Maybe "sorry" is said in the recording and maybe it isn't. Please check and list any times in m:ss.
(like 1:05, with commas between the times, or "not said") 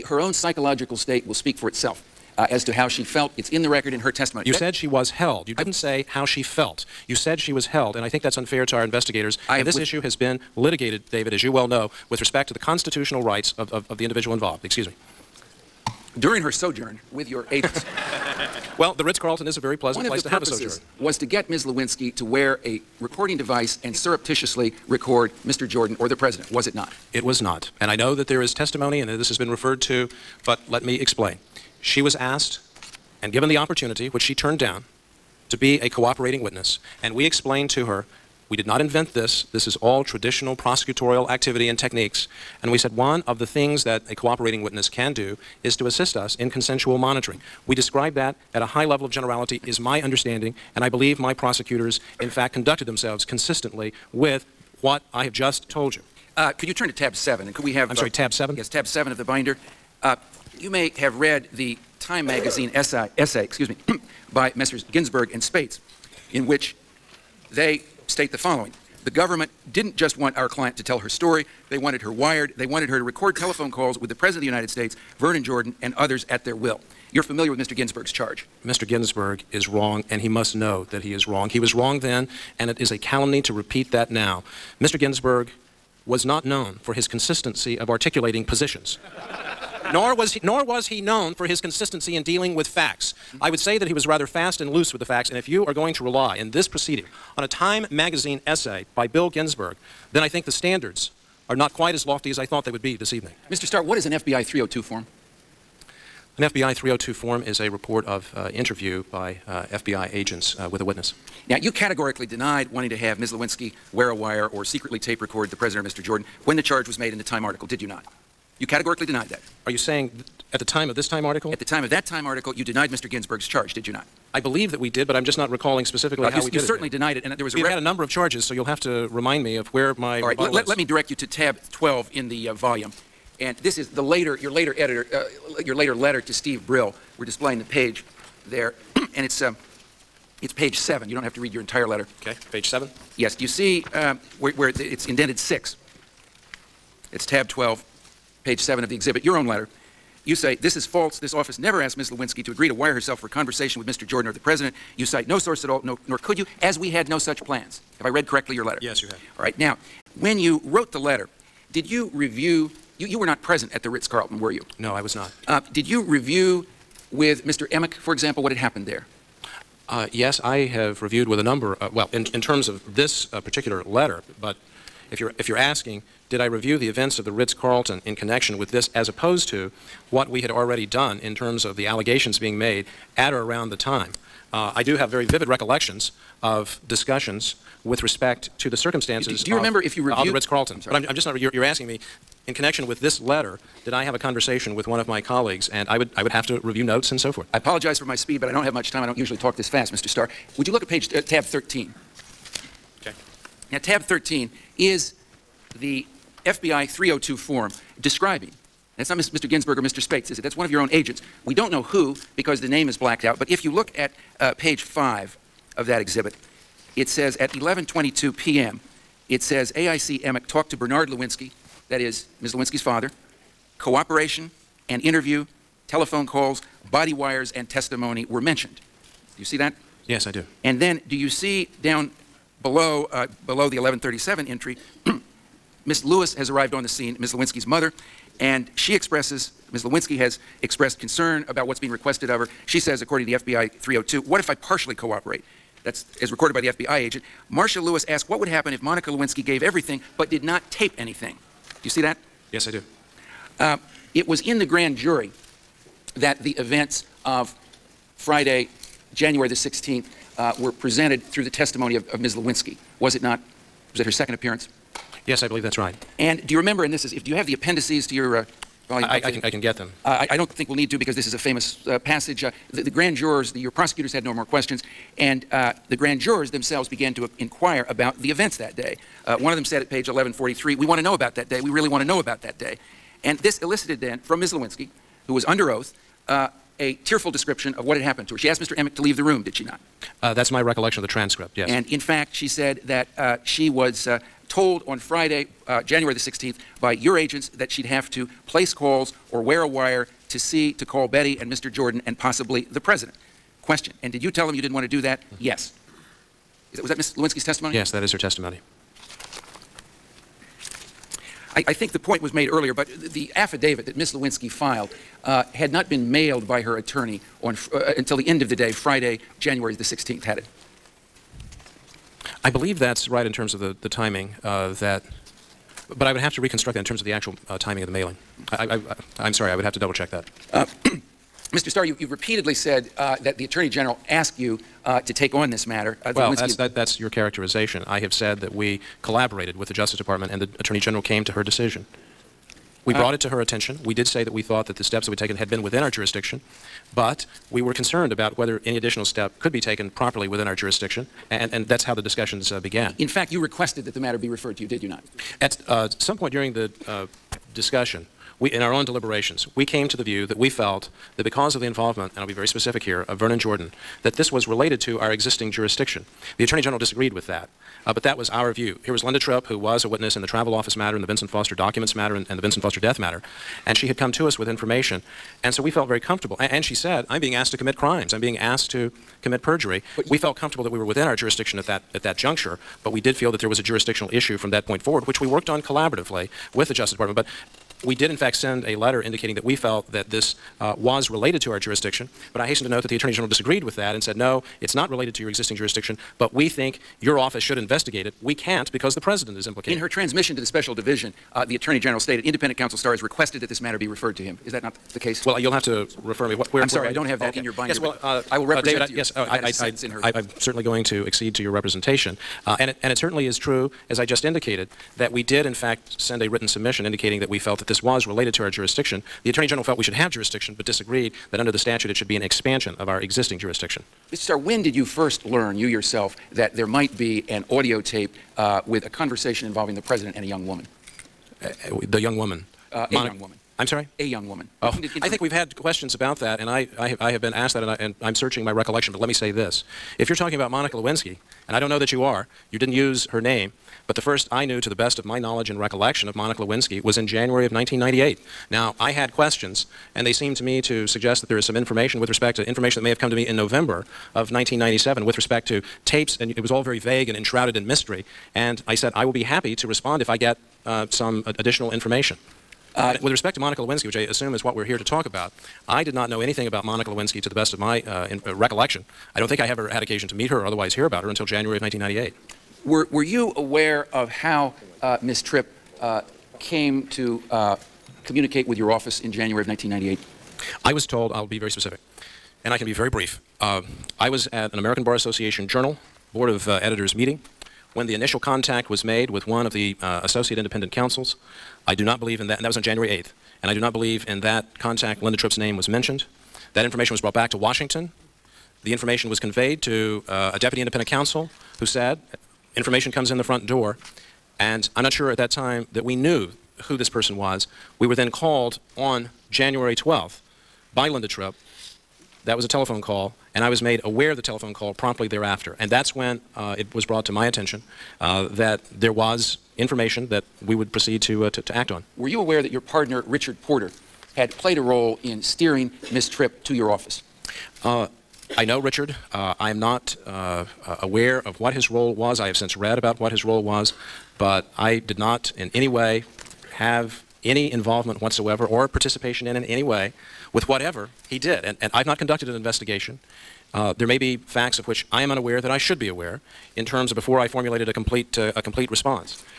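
0:57, 3:10, 5:29, 6:46, 7:13.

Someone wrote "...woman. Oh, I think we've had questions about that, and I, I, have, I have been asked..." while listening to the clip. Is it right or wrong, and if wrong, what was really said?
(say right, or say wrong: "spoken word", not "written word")
right.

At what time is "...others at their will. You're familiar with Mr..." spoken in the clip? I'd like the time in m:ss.
1:15.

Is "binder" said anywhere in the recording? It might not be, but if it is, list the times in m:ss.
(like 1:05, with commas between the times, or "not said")
0:59, 6:47.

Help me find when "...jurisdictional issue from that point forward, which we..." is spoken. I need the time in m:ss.
6:23.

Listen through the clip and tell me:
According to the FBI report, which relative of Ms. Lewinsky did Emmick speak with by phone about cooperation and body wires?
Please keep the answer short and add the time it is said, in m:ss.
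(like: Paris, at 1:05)
Bernard Lewinsky, at 3:40.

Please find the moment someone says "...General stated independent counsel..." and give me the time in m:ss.
6:41.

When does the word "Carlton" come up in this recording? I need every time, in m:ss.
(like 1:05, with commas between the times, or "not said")
0:19, 2:43, 2:57, 3:10.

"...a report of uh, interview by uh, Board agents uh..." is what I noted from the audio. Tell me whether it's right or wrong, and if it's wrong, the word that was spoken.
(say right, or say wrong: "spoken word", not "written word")
wrong: "FBI", not "Board".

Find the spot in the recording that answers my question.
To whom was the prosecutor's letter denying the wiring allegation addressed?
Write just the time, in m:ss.
2:16.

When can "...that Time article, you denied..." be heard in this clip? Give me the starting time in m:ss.
2:01.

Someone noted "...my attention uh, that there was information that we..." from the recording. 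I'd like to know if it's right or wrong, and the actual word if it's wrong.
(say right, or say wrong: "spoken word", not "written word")
right.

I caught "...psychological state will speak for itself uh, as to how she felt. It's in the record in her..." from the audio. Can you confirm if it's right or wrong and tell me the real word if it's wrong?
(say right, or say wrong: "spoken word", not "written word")
right.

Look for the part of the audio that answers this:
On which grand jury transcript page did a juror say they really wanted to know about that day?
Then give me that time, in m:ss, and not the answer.
4:40.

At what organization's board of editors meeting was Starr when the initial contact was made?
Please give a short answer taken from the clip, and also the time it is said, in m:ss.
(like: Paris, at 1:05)
American Bar Association Journal, at 8:04.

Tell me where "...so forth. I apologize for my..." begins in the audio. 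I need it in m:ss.
3:17.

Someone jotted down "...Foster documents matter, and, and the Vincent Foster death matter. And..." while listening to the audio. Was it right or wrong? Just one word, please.
right.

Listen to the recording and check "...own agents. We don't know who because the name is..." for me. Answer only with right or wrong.
right.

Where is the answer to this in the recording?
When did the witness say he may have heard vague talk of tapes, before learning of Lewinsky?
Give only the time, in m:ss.
7:33.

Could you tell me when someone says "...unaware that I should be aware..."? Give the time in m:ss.
9:05.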